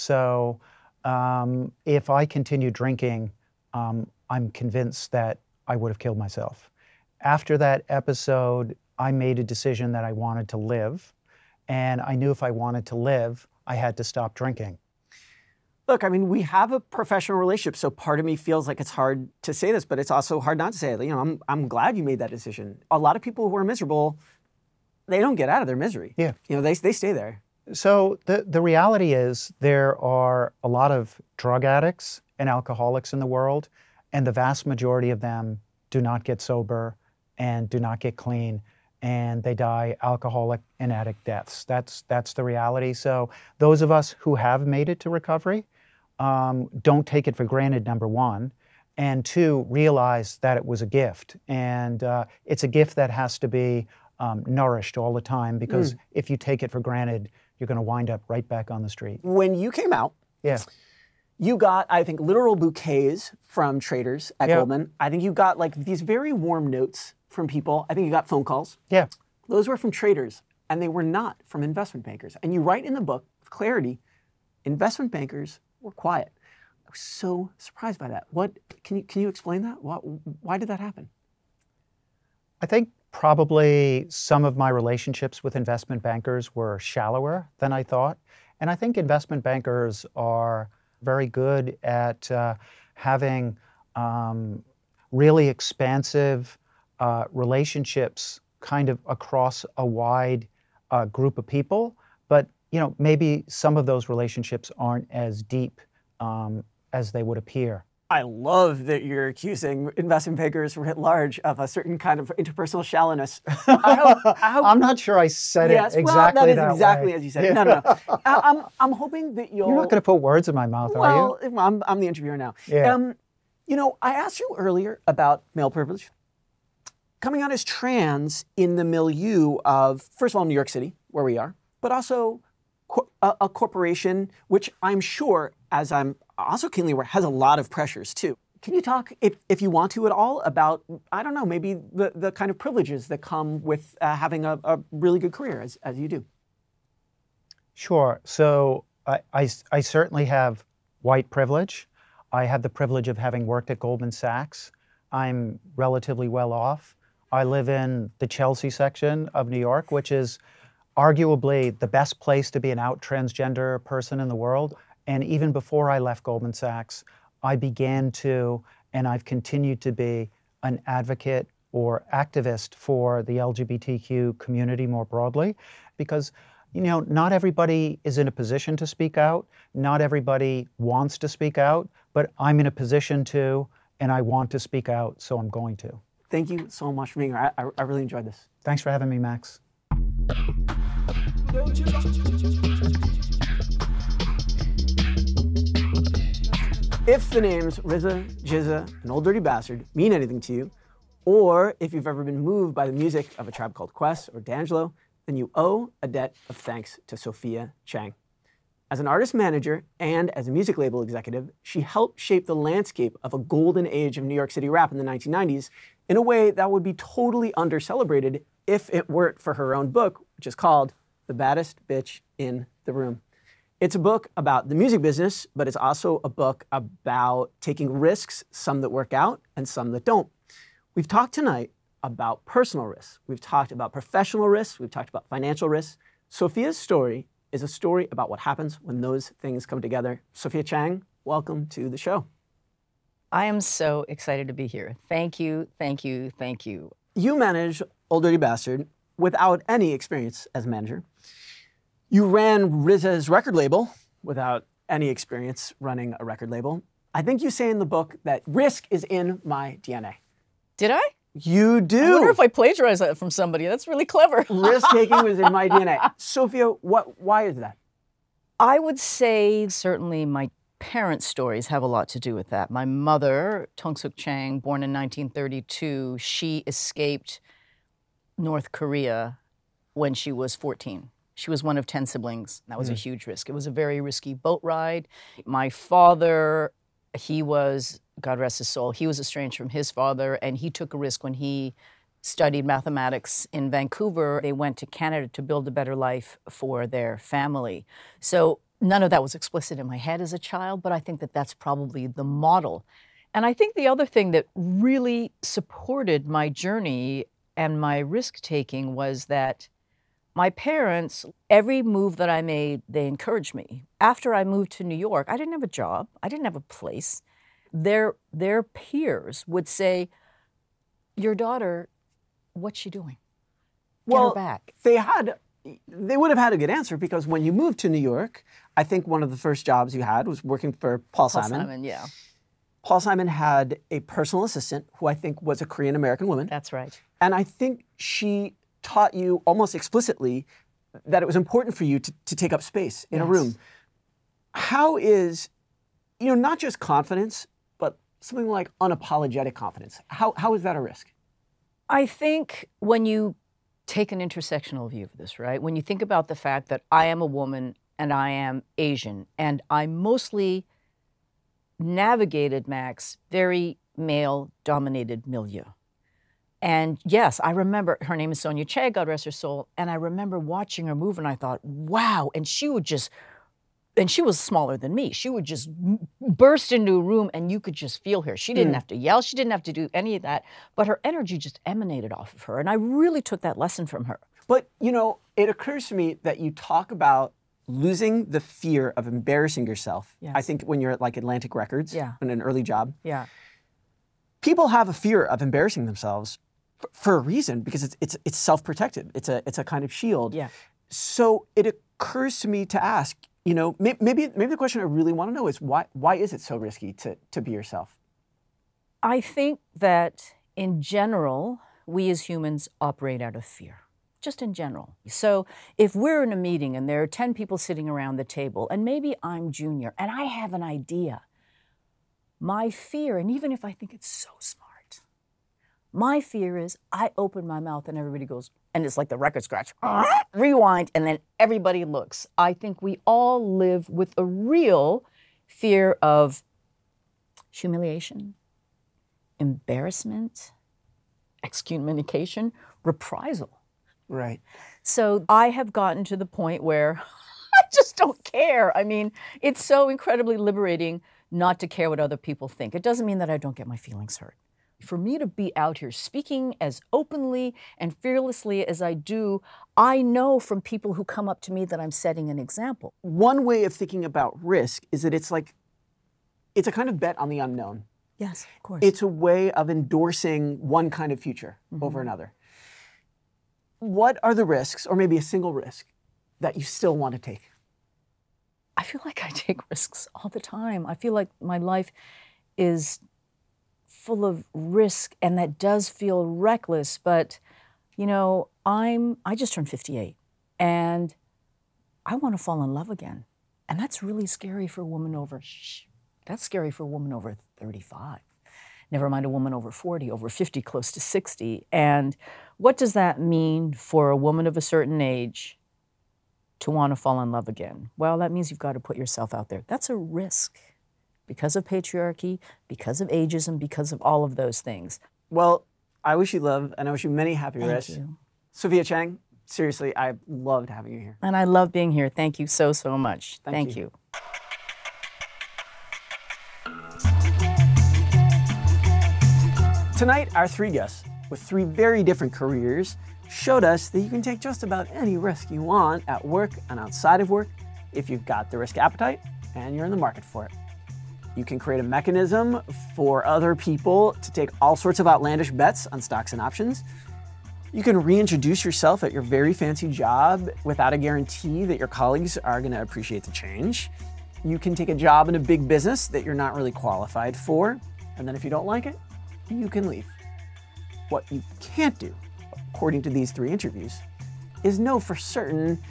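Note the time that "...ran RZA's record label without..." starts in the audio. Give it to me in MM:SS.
04:12.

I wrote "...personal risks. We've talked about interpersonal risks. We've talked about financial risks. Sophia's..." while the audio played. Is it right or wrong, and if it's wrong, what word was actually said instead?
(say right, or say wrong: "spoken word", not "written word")
wrong: "professional", not "interpersonal".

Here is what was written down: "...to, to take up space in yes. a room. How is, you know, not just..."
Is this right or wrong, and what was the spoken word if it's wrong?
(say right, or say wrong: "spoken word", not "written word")
right.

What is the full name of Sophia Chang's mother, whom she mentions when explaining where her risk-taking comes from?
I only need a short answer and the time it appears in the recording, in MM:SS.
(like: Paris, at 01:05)
Tong Suk Chang, at 04:33.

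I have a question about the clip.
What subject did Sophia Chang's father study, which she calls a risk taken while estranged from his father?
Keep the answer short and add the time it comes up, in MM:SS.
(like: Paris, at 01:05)
Mathematics, at 04:52.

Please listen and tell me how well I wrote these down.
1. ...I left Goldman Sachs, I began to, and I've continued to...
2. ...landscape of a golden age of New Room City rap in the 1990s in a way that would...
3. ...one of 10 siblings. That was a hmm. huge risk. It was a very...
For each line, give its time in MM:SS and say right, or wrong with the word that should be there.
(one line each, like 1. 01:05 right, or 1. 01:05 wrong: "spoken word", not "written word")
1. 02:45 right
2. 03:32 wrong: "York", not "Room"
3. 04:41 right.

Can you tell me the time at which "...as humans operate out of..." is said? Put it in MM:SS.
06:52.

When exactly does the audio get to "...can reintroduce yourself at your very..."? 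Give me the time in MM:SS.
09:07.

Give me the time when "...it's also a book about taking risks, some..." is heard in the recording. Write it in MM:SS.
03:45.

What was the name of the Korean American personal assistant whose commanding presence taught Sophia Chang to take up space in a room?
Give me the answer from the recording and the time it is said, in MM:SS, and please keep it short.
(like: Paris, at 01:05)
Sonia Che, at 06:08.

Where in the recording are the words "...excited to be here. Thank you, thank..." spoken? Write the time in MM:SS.
04:04.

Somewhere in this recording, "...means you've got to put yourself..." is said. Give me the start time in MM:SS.
08:28.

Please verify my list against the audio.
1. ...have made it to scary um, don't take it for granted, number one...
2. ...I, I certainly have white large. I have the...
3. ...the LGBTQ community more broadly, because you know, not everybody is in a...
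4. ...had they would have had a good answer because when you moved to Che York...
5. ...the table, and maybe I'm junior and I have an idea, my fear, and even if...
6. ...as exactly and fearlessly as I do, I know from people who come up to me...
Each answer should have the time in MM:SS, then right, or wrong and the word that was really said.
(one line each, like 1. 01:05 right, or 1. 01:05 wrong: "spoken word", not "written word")
1. 00:44 wrong: "recovery", not "scary"
2. 02:29 wrong: "privilege", not "large"
3. 02:53 right
4. 05:24 wrong: "New", not "Che"
5. 06:58 right
6. 07:36 wrong: "openly", not "exactly".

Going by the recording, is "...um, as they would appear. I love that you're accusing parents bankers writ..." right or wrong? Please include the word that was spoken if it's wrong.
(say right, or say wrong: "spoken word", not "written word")
wrong: "investment", not "parents".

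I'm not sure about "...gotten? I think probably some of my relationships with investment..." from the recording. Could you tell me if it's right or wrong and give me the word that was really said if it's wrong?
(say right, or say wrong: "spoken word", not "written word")
wrong: "happen", not "gotten".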